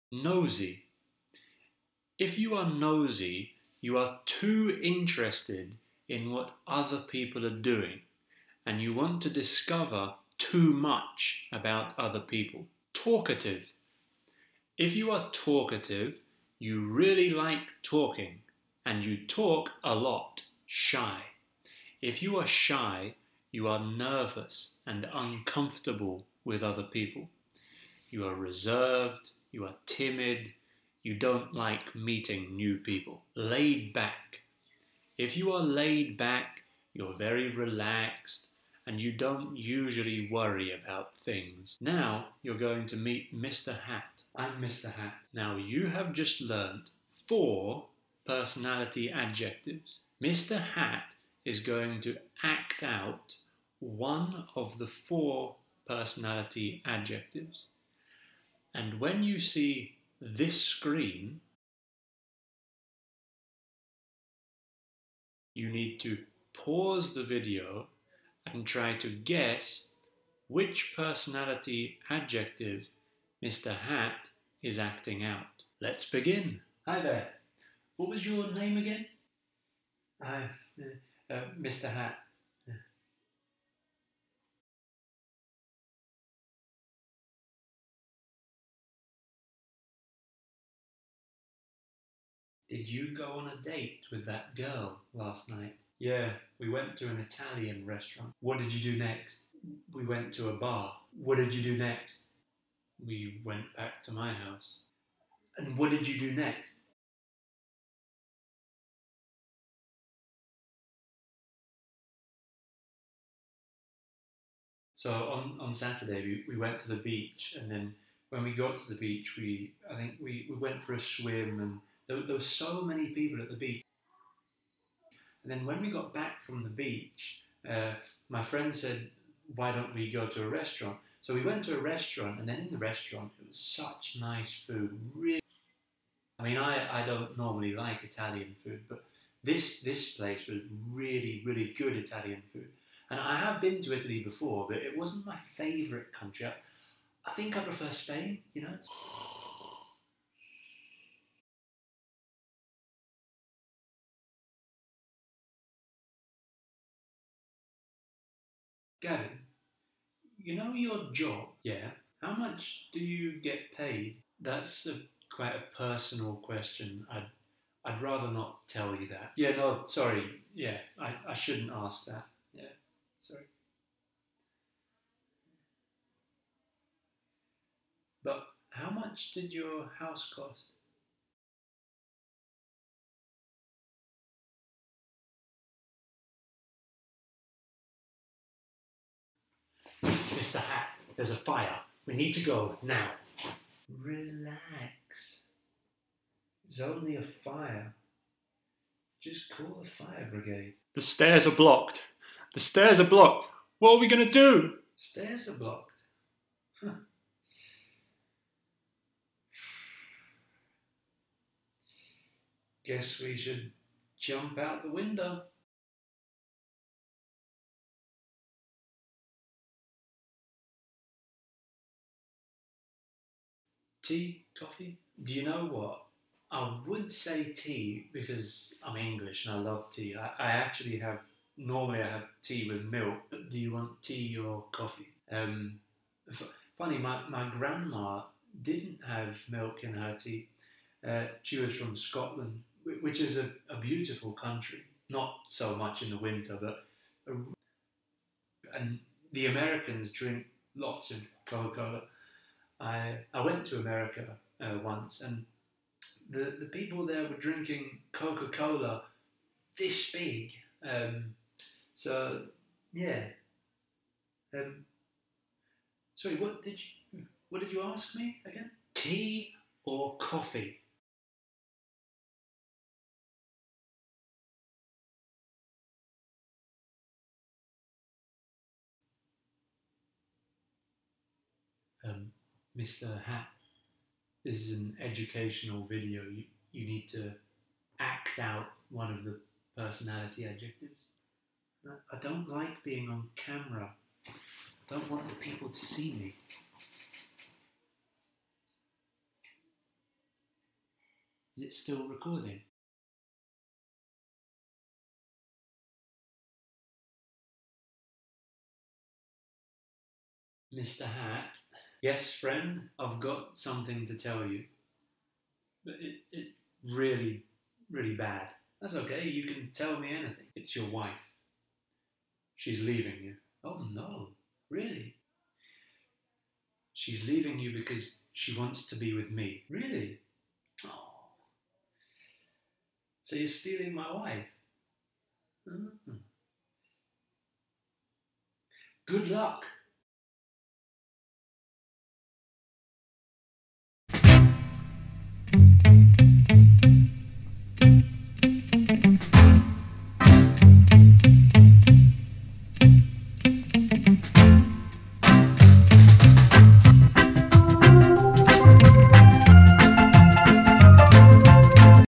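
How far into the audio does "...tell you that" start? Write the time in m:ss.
2:48.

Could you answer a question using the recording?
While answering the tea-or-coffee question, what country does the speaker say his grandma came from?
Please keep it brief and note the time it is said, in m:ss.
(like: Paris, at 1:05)
Scotland, at 4:01.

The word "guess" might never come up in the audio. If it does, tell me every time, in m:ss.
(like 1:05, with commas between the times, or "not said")
1:09, 3:32.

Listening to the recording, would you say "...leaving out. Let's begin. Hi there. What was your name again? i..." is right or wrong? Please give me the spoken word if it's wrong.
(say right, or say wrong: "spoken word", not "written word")
wrong: "acting", not "leaving".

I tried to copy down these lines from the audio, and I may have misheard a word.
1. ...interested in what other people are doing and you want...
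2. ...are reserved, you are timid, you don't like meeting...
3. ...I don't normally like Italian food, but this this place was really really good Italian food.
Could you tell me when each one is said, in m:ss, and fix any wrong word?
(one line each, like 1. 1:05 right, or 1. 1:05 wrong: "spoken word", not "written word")
1. 0:04 right
2. 0:28 right
3. 2:17 right.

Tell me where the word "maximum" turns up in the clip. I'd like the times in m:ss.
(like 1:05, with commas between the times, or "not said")
not said.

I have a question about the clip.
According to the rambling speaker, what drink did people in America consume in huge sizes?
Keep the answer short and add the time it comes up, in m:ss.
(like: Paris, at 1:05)
Coca-Cola, at 4:18.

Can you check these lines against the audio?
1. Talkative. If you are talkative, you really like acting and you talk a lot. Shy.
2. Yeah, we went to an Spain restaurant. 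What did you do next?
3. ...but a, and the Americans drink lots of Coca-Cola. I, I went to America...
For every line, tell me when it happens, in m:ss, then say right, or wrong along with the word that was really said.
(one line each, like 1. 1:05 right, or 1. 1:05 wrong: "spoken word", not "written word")
1. 0:12 wrong: "talking", not "acting"
2. 1:35 wrong: "Italian", not "Spain"
3. 4:06 right.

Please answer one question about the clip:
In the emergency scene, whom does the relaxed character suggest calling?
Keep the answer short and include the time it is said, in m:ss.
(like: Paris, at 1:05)
The fire brigade, at 3:19.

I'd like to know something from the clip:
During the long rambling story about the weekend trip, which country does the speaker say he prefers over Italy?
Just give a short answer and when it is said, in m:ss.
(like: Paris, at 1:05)
Spain, at 2:27.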